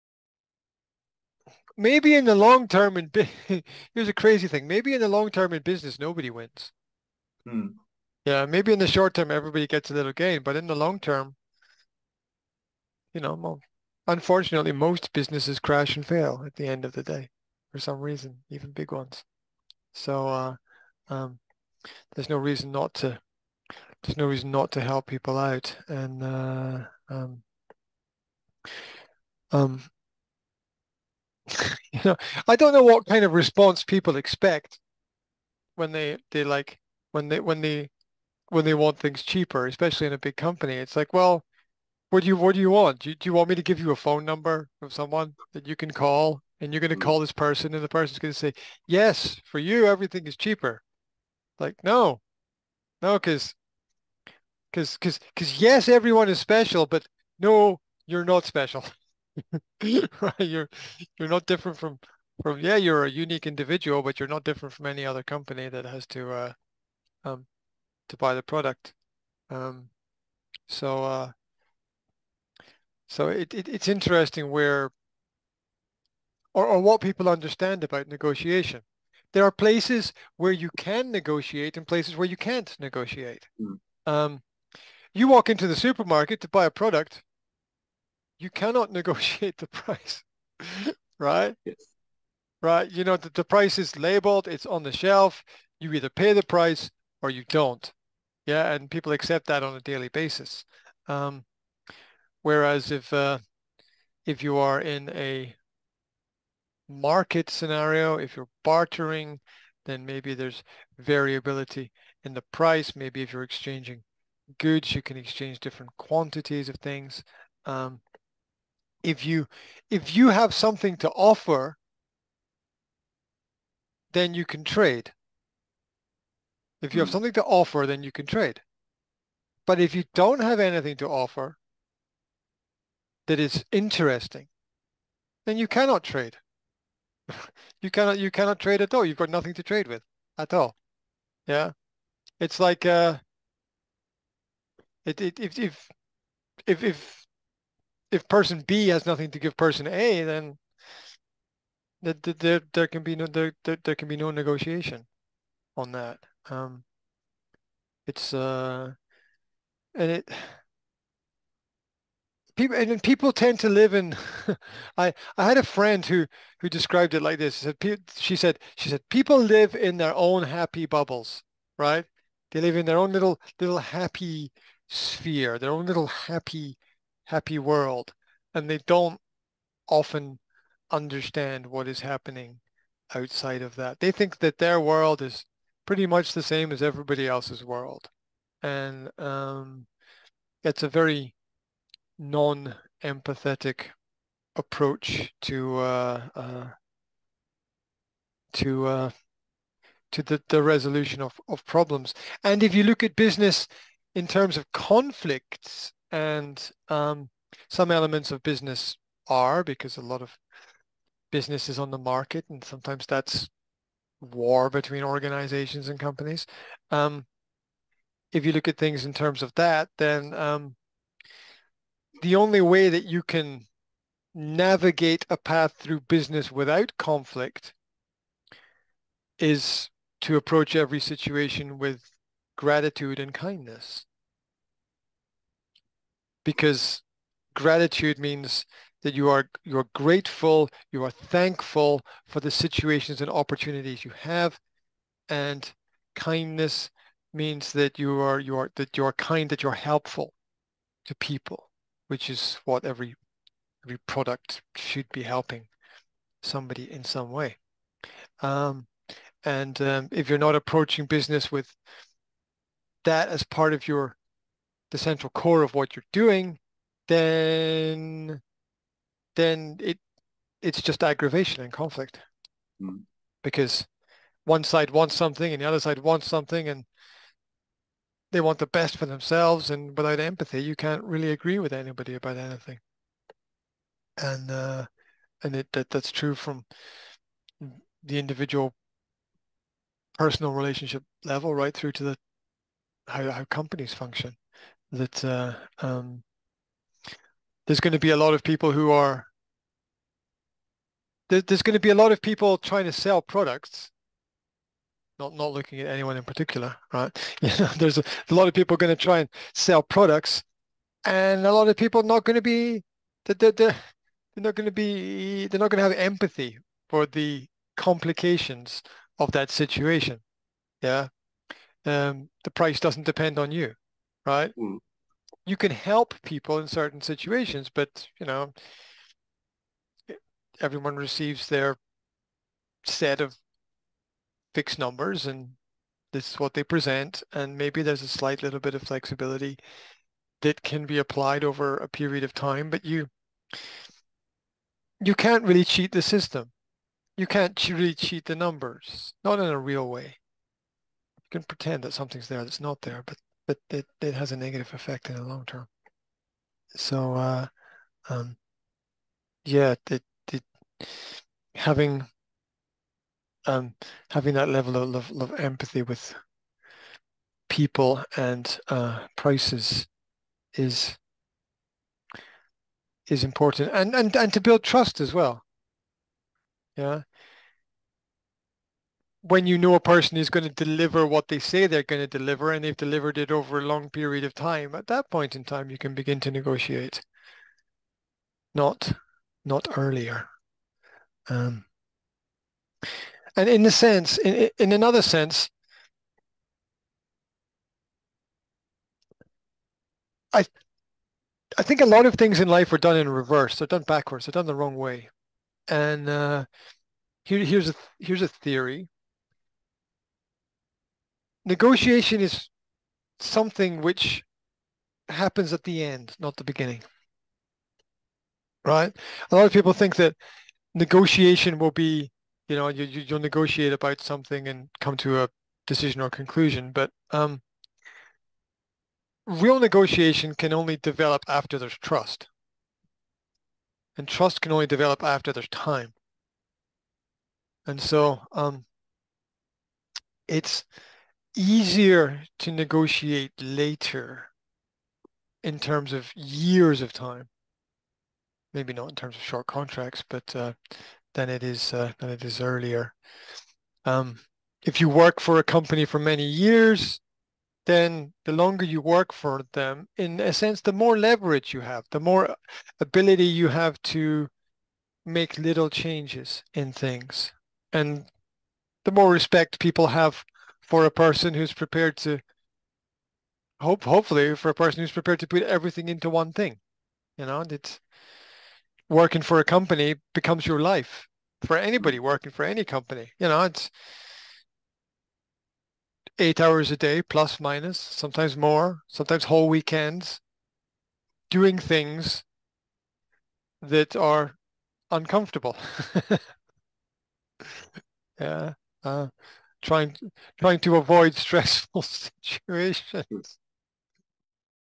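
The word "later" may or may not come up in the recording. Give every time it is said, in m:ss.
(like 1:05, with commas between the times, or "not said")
7:23.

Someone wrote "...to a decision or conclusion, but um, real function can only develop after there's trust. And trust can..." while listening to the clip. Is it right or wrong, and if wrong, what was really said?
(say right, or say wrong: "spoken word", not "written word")
wrong: "negotiation", not "function".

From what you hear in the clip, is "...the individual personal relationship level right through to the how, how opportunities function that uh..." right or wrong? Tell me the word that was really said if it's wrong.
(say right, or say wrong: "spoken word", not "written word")
wrong: "companies", not "opportunities".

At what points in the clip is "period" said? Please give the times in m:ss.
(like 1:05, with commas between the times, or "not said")
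5:41, 6:23.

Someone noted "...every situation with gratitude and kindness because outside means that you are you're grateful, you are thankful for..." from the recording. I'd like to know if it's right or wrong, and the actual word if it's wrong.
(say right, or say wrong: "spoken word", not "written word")
wrong: "gratitude", not "outside".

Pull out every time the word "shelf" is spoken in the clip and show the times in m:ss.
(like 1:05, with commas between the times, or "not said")
1:34.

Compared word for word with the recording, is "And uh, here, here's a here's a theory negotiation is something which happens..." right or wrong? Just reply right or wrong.
right.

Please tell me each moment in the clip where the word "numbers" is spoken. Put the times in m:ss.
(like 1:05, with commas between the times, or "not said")
0:44, 5:34, 5:48.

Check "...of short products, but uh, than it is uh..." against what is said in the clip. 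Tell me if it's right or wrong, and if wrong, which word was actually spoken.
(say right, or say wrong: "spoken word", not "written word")
wrong: "contracts", not "products".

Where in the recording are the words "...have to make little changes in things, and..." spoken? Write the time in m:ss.
7:43.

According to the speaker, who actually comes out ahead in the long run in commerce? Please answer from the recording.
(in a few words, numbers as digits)
nobody.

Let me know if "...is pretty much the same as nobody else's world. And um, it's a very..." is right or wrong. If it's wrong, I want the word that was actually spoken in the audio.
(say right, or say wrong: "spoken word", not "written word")
wrong: "everybody", not "nobody".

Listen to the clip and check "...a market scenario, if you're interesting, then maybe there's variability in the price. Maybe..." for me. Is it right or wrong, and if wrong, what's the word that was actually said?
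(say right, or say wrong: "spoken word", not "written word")
wrong: "bartering", not "interesting".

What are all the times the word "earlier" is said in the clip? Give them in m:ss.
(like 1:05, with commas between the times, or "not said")
6:29, 7:32.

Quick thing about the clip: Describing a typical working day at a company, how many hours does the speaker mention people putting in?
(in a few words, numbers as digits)
8.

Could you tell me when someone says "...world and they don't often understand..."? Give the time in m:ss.
2:57.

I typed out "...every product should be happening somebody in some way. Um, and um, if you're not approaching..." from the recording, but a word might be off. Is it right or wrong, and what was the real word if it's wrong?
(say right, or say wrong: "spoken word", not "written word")
wrong: "helping", not "happening".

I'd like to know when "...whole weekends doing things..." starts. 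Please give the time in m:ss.
8:09.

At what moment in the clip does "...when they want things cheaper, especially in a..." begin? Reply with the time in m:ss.
0:38.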